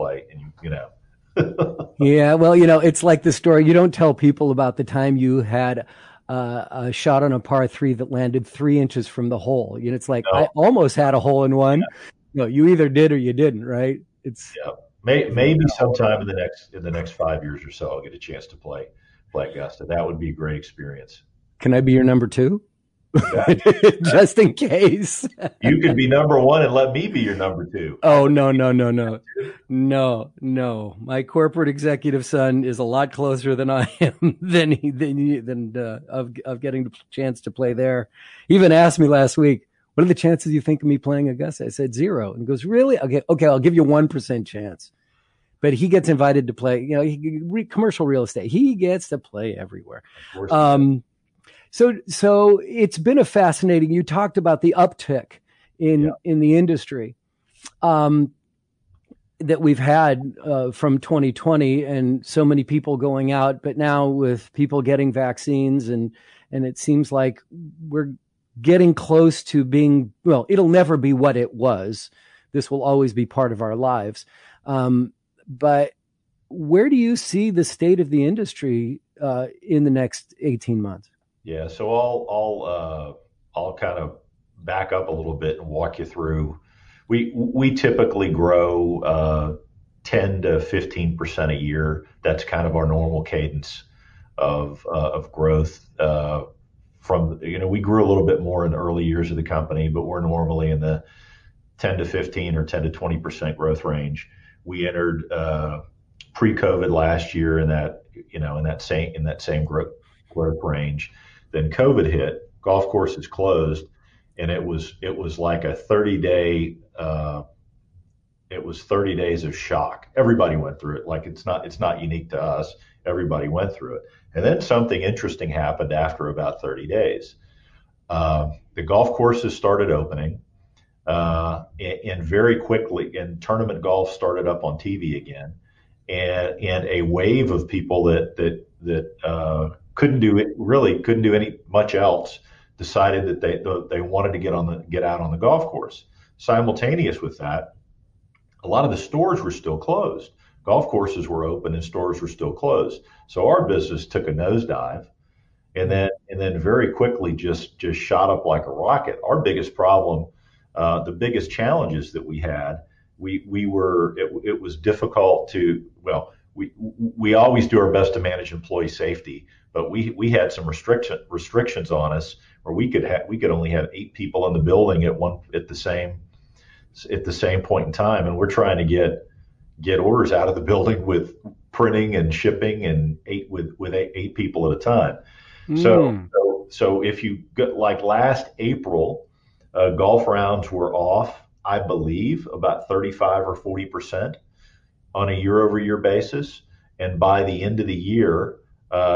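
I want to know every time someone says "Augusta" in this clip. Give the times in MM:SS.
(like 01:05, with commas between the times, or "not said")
00:19, 00:41.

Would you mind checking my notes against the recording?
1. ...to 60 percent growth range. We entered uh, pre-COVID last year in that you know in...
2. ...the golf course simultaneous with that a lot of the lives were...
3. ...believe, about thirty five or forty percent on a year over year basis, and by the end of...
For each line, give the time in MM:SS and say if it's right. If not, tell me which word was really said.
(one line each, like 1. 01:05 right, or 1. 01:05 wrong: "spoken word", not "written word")
1. 01:42 wrong: "20", not "60"
2. 02:25 wrong: "stores", not "lives"
3. 03:11 right.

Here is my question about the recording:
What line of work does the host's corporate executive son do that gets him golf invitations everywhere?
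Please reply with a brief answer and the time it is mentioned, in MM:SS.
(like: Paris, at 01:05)
Commercial real estate, at 00:47.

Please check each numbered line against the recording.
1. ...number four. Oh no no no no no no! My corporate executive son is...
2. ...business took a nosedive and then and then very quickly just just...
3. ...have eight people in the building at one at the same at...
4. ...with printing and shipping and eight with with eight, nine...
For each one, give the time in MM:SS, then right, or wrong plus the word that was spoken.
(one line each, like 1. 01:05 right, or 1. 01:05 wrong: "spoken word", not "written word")
1. 00:27 wrong: "two", not "four"
2. 02:33 right
3. 02:53 right
4. 03:01 wrong: "eight", not "nine".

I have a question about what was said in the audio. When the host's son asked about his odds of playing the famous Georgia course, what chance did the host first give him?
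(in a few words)
0.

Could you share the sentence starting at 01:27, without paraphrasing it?
We we typically grow uh, 10 to 15 percent a year.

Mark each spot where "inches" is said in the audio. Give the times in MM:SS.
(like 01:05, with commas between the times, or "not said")
00:08.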